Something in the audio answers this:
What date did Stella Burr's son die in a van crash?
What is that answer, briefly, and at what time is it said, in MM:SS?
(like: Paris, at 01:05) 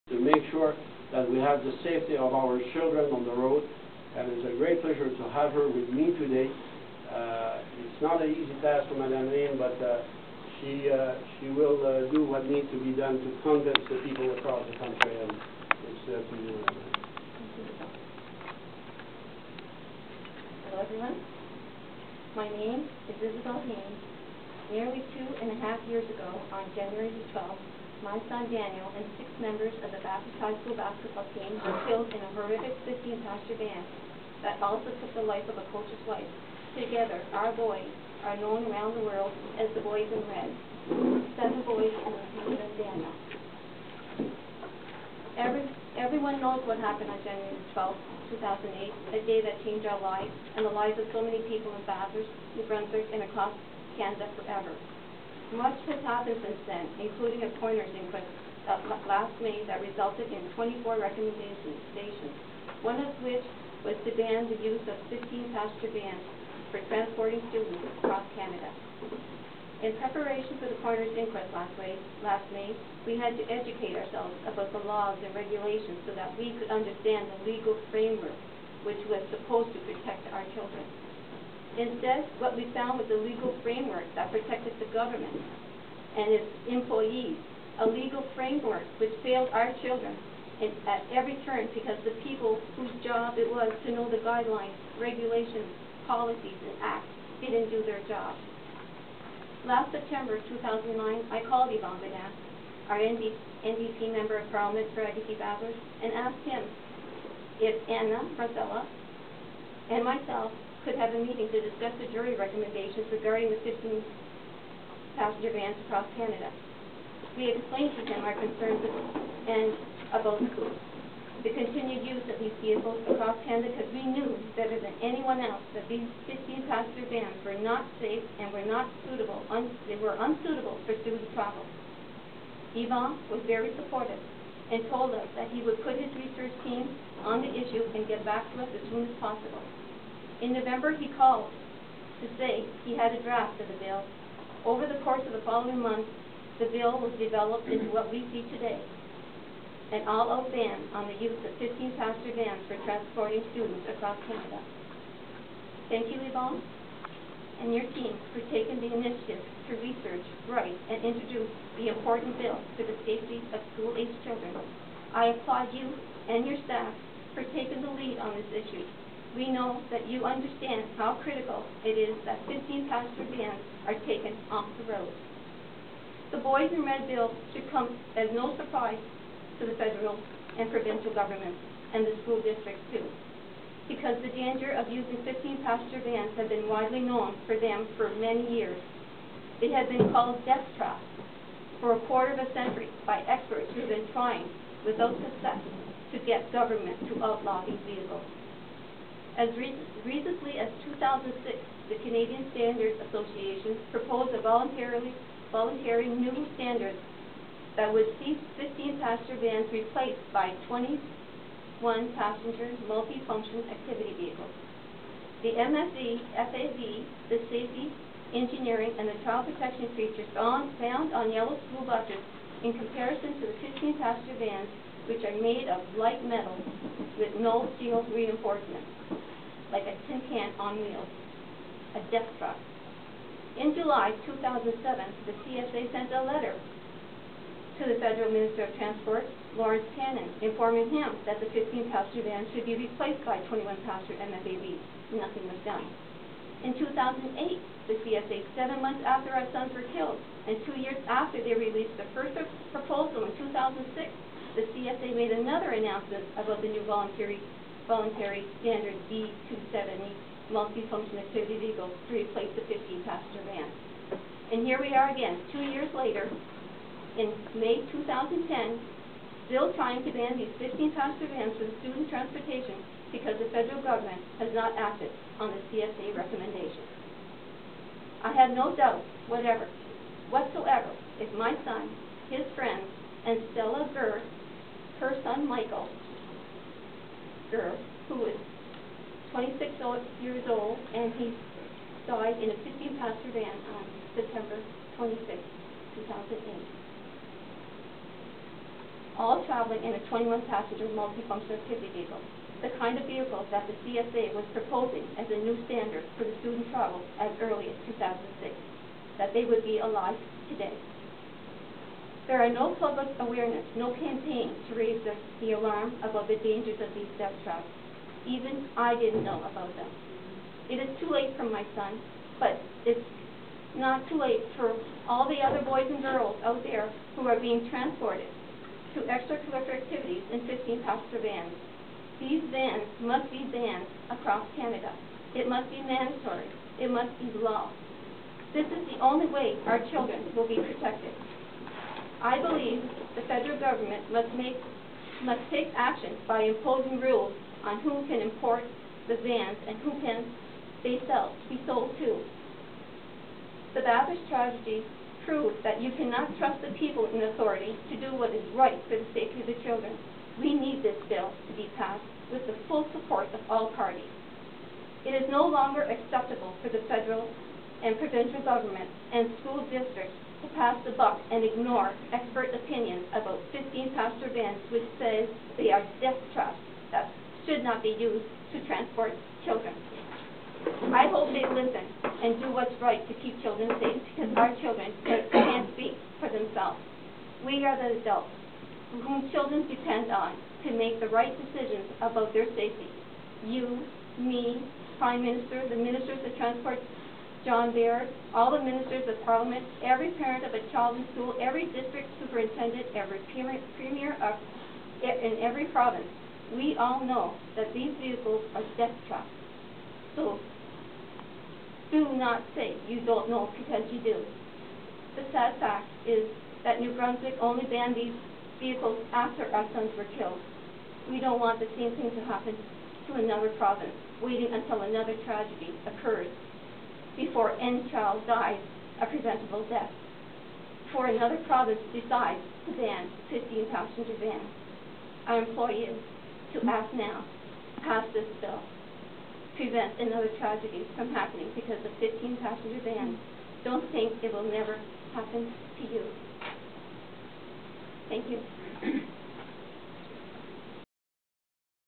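September 26, 2008, at 04:54.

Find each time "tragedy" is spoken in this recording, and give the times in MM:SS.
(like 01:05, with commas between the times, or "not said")
05:54, 07:05, 07:20.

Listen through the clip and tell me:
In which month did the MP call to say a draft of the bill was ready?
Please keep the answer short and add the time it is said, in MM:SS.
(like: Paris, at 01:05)
November, at 02:20.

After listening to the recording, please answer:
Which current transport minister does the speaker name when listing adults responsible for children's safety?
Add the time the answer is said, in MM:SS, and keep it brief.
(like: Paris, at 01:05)
John Baird, at 06:37.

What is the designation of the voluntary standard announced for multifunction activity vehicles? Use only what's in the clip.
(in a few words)
B270.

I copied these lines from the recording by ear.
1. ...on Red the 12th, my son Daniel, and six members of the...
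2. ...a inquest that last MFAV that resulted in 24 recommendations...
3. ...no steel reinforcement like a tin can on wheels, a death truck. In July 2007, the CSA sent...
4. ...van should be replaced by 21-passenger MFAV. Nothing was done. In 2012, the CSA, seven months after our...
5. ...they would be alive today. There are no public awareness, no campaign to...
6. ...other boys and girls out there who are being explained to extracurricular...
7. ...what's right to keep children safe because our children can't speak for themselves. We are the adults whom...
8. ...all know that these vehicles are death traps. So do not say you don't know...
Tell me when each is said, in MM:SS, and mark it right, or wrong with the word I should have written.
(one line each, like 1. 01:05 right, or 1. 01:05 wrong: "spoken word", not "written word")
1. 00:26 wrong: "January", not "Red"
2. 00:57 wrong: "May", not "MFAV"
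3. 03:47 right
4. 04:02 wrong: "2008", not "2012"
5. 05:09 right
6. 05:25 wrong: "transported", not "explained"
7. 06:22 right
8. 06:46 right.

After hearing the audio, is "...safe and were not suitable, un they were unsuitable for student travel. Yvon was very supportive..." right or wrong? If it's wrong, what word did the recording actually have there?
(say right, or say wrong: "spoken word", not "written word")
right.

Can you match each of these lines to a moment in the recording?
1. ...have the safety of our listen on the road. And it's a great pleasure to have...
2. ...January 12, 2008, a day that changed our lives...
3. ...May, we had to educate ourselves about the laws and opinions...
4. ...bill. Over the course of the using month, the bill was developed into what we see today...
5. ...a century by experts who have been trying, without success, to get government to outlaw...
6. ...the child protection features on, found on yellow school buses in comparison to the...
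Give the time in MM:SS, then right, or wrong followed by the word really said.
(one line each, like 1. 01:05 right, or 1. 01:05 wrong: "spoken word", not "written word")
1. 00:01 wrong: "children", not "listen"
2. 00:47 right
3. 01:12 wrong: "regulations", not "opinions"
4. 02:23 wrong: "following", not "using"
5. 03:12 right
6. 03:39 right.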